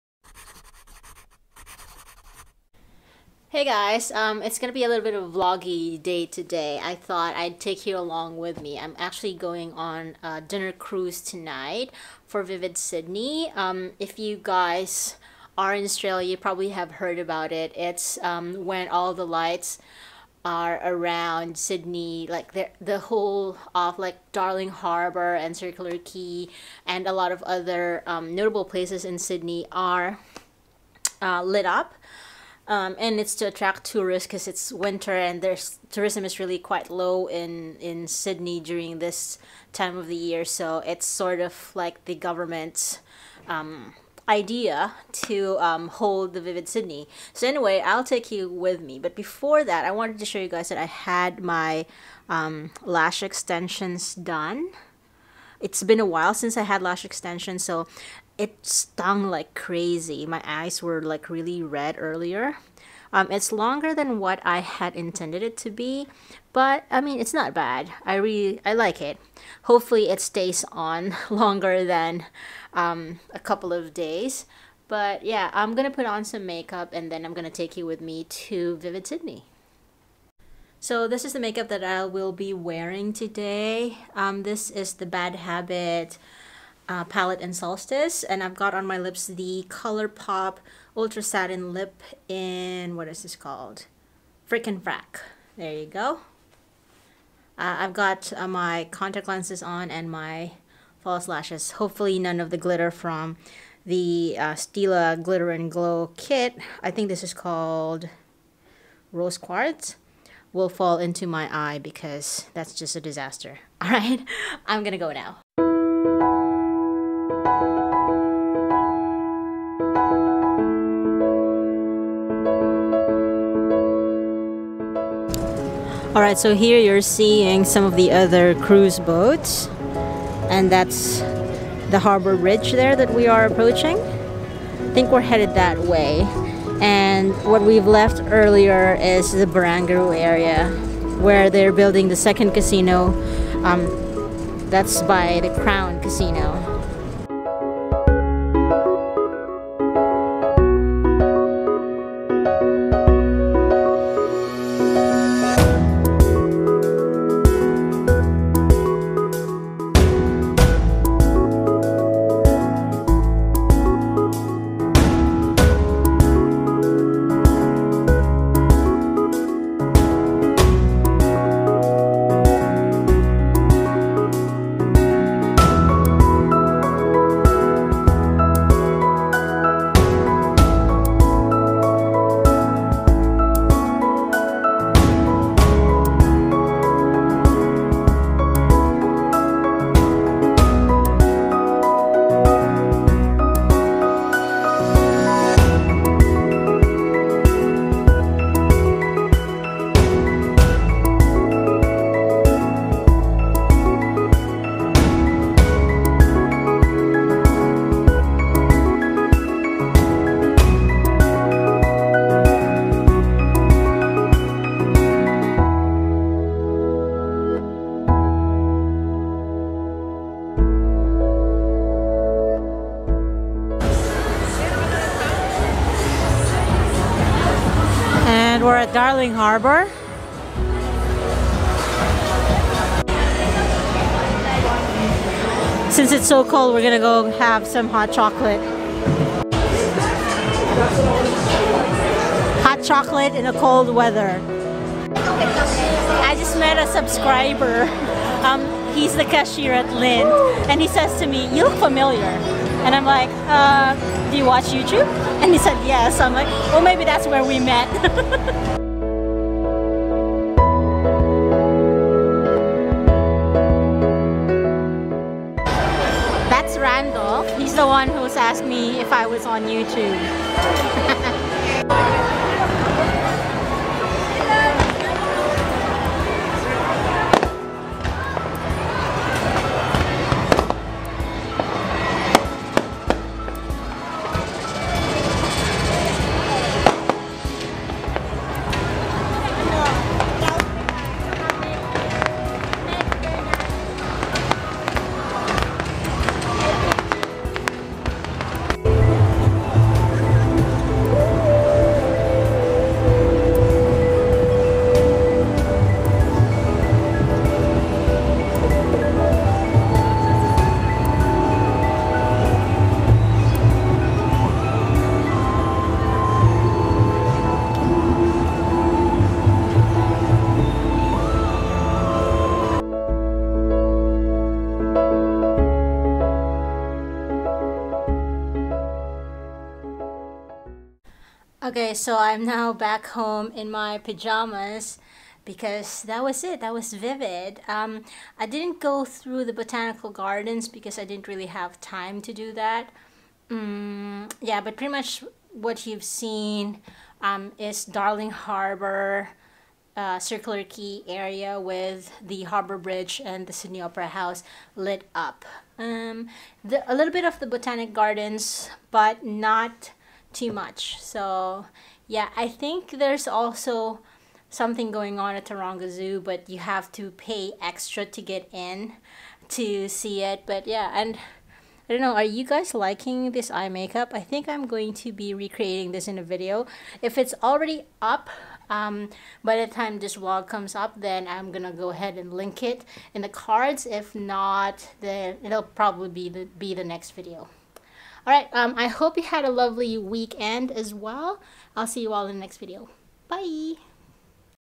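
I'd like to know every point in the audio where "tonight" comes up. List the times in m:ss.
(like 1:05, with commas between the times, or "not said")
0:11.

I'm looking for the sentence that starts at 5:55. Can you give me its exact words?
Um, the, a little bit of the Botanic Gardens, but not too much.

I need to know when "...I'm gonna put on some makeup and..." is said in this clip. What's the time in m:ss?
1:15.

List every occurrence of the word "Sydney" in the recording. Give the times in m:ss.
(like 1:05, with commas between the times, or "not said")
0:12, 0:21, 0:29, 0:38, 0:46, 1:19, 5:53.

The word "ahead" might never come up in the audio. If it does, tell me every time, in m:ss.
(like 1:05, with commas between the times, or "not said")
6:21.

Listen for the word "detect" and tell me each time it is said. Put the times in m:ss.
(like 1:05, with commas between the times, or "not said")
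not said.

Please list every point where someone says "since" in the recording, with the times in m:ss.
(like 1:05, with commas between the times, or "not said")
0:56, 3:55.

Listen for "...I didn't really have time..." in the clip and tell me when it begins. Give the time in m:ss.
5:40.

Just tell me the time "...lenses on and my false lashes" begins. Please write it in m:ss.
1:39.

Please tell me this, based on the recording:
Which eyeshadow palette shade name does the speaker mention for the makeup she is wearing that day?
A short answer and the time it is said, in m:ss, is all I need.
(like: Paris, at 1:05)
Solstice, at 1:27.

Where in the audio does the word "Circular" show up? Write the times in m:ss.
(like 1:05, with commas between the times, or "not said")
0:25, 5:50.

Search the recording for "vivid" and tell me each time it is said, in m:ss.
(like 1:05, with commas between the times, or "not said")
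0:12, 0:46, 1:18, 5:36.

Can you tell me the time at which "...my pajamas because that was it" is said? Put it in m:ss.
5:33.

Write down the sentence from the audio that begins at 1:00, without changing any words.
My eyes were like really red earlier.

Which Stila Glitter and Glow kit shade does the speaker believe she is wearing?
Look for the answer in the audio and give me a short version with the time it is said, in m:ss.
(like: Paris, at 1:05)
Rose Quartz, at 1:49.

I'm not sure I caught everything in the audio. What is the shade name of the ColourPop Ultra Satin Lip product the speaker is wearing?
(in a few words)
Frickin' Frack.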